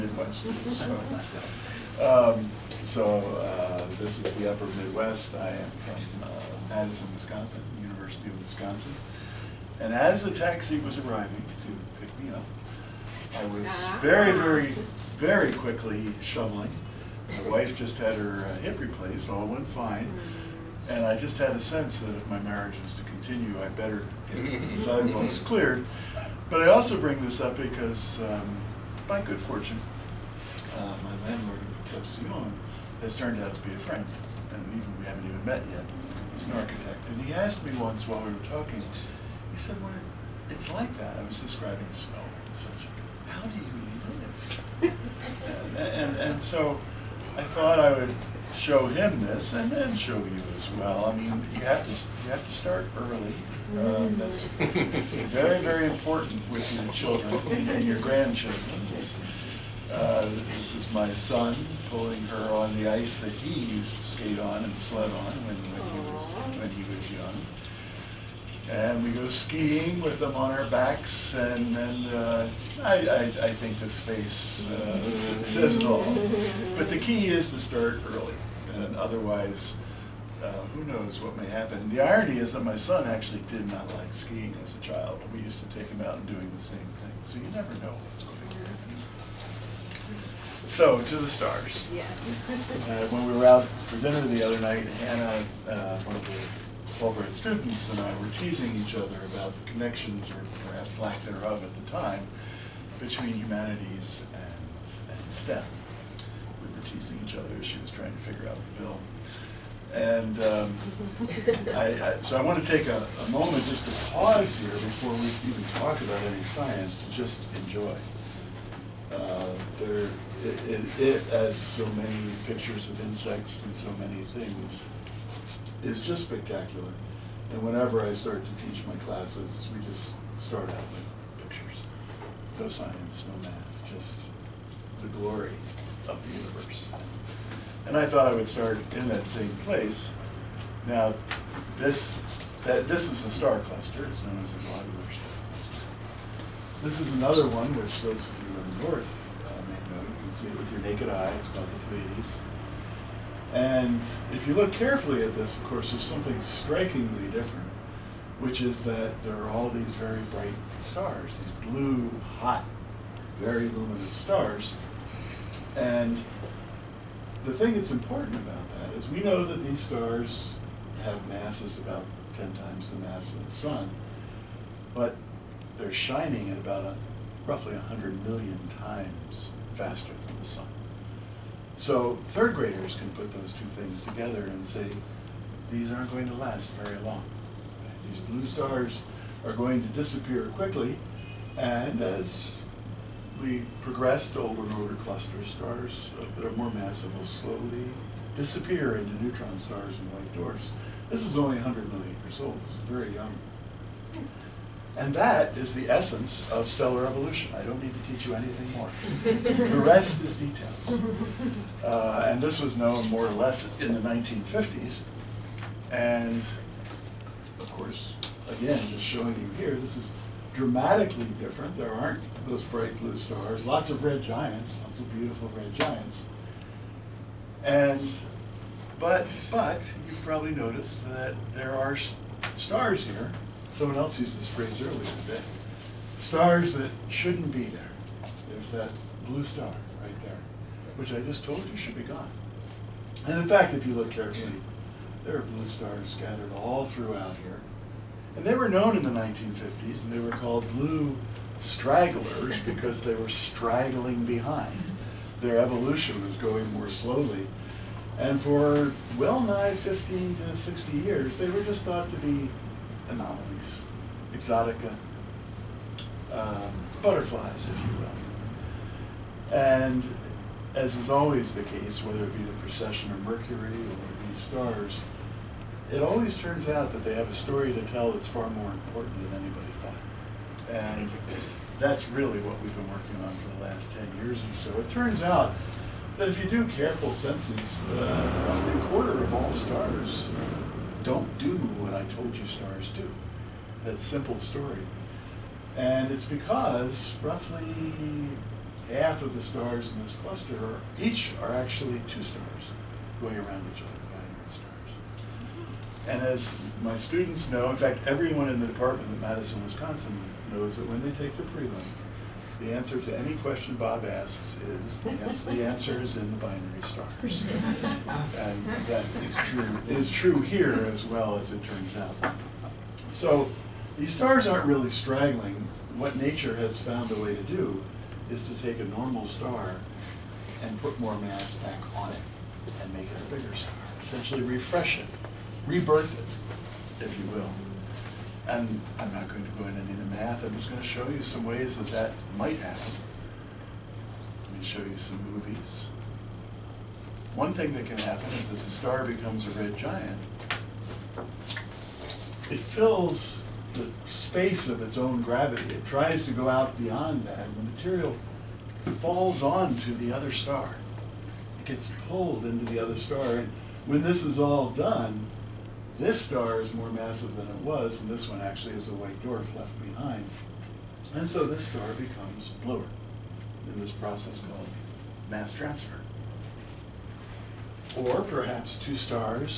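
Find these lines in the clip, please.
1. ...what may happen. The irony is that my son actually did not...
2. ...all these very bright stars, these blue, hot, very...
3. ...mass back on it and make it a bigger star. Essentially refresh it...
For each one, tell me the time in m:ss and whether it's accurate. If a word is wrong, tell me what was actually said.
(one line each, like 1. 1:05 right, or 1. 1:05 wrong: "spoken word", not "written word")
1. 1:21 right
2. 2:39 right
3. 5:31 right.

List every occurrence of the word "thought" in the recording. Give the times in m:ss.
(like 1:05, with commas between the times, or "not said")
0:47, 2:18, 4:21, 4:39.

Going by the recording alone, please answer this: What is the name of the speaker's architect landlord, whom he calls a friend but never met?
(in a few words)
Concepcion.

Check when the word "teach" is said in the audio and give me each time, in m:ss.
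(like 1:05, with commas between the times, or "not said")
2:08, 3:28.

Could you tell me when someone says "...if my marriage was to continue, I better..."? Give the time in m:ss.
0:22.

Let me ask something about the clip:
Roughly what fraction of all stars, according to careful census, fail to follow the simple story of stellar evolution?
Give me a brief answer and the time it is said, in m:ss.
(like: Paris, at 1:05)
a quarter, at 4:48.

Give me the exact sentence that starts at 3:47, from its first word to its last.
And, but, but, you've probably noticed that there are stars here someone else used this phrase earlier today.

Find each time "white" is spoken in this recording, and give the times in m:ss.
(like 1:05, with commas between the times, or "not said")
3:20, 6:08.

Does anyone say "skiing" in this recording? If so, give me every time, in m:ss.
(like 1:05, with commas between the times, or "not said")
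1:09, 1:24.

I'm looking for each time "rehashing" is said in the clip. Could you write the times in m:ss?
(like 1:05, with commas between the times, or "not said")
not said.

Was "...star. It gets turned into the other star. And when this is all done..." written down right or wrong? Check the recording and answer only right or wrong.
wrong.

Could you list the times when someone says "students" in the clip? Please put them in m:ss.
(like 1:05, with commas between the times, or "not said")
1:37, 5:06.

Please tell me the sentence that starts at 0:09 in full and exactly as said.
And as the taxi was arriving to you know.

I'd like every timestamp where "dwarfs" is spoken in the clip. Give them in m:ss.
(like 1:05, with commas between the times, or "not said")
3:20, 6:09.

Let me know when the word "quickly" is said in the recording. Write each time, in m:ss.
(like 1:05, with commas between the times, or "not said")
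0:15, 3:10.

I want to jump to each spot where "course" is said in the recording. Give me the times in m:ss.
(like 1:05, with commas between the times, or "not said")
2:35, 3:37.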